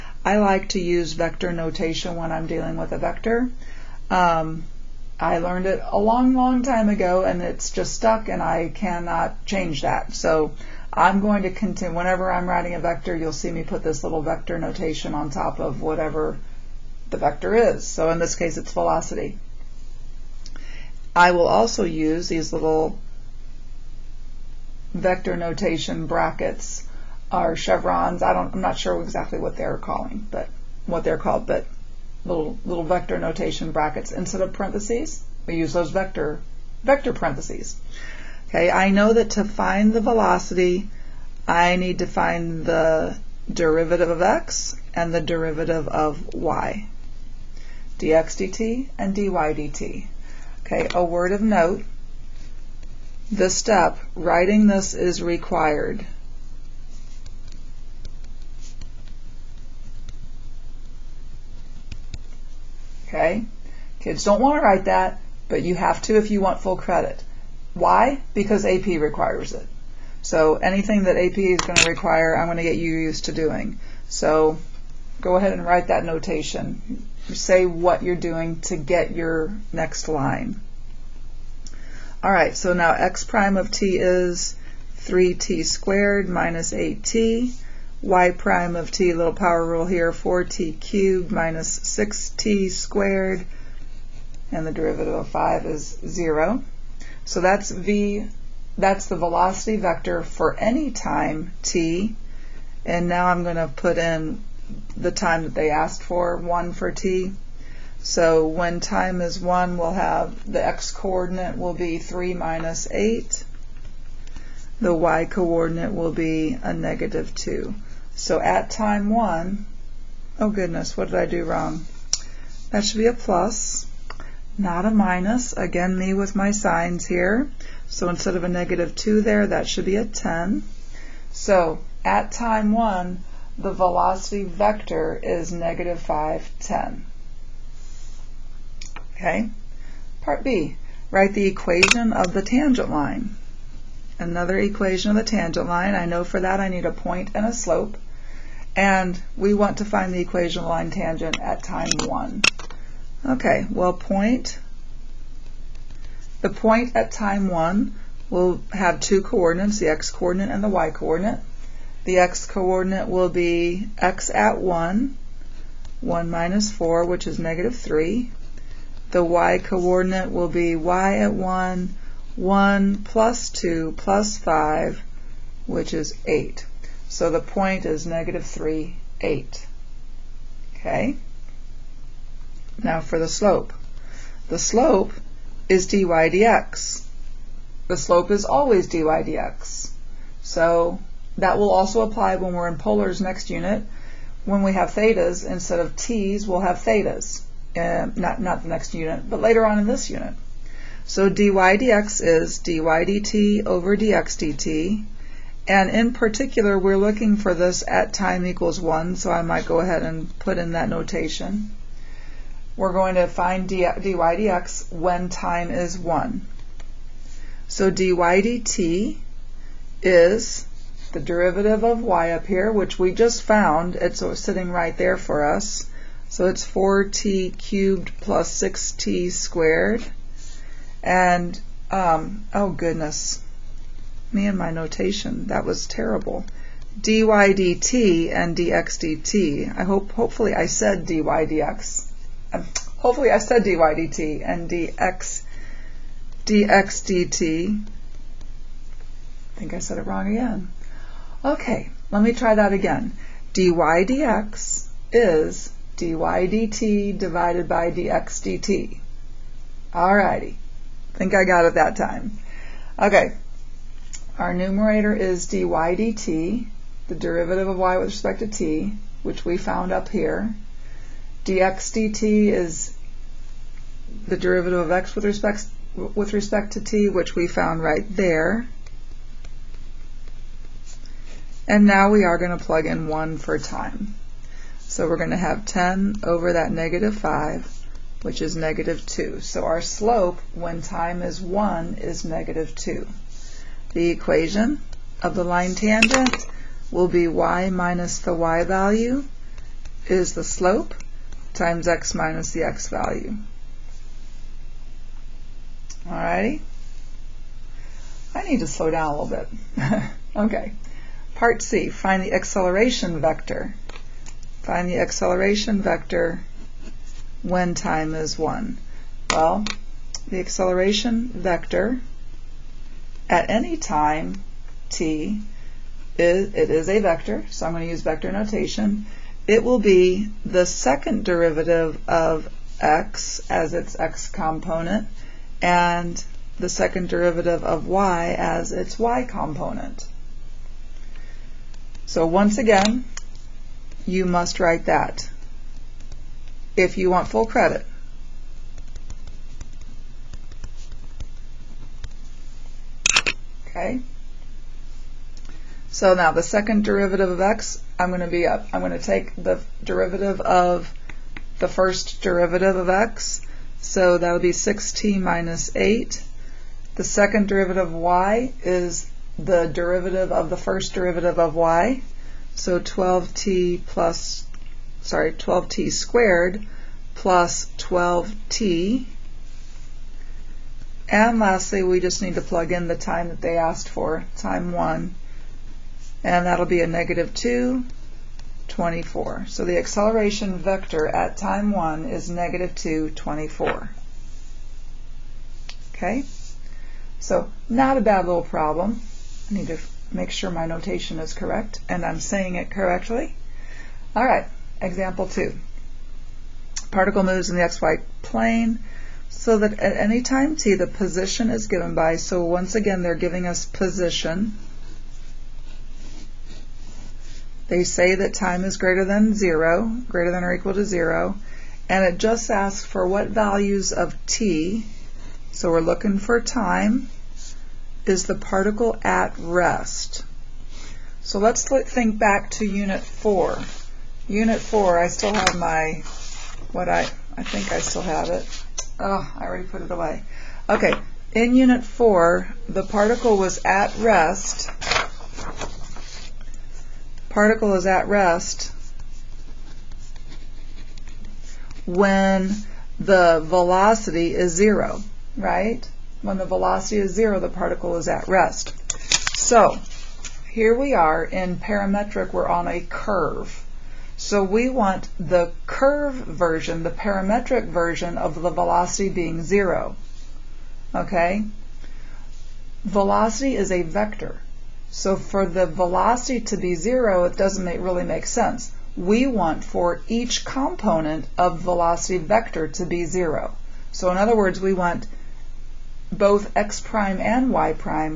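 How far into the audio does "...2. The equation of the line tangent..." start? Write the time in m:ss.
4:52.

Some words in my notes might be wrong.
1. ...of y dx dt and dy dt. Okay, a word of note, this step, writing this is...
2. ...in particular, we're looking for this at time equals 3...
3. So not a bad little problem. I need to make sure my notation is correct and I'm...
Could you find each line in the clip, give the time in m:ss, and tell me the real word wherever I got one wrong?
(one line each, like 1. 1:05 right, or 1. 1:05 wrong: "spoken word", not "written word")
1. 0:45 right
2. 3:25 wrong: "1", not "3"
3. 6:37 right.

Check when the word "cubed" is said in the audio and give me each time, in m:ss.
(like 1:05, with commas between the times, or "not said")
1:30, 3:47.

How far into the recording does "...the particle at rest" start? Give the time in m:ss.
7:08.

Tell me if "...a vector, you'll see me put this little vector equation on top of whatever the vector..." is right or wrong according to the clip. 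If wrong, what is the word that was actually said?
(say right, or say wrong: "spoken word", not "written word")
wrong: "notation", not "equation".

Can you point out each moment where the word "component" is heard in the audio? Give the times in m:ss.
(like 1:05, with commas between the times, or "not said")
5:34, 5:39, 8:00.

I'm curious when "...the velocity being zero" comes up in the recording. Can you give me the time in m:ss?
7:48.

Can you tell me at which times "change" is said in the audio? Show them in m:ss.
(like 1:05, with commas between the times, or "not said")
0:09.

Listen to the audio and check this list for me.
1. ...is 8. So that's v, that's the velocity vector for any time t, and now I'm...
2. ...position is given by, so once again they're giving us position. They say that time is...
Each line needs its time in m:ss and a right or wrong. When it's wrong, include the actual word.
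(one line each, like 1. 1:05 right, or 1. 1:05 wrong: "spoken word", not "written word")
1. 1:35 wrong: "0", not "8"
2. 6:50 right.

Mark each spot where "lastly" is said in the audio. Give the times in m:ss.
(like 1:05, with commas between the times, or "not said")
6:21.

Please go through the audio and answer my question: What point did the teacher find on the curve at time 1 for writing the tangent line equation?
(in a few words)
(-3, 8).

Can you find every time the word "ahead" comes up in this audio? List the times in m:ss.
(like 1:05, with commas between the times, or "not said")
1:15, 3:29.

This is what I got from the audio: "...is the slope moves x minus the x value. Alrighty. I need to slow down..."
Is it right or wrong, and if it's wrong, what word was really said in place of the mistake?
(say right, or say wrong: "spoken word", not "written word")
wrong: "times", not "moves".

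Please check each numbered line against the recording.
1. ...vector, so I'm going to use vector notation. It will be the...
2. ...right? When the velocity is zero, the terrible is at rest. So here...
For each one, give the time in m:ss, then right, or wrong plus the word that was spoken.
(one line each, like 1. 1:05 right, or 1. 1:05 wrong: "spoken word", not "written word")
1. 5:26 right
2. 7:35 wrong: "particle", not "terrible".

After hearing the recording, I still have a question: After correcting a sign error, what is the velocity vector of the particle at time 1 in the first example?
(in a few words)
-5, 10.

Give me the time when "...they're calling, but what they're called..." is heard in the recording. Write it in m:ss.
0:29.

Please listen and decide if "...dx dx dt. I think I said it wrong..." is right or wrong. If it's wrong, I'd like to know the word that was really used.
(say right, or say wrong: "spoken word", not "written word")
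right.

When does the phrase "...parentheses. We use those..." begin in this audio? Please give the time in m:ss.
0:34.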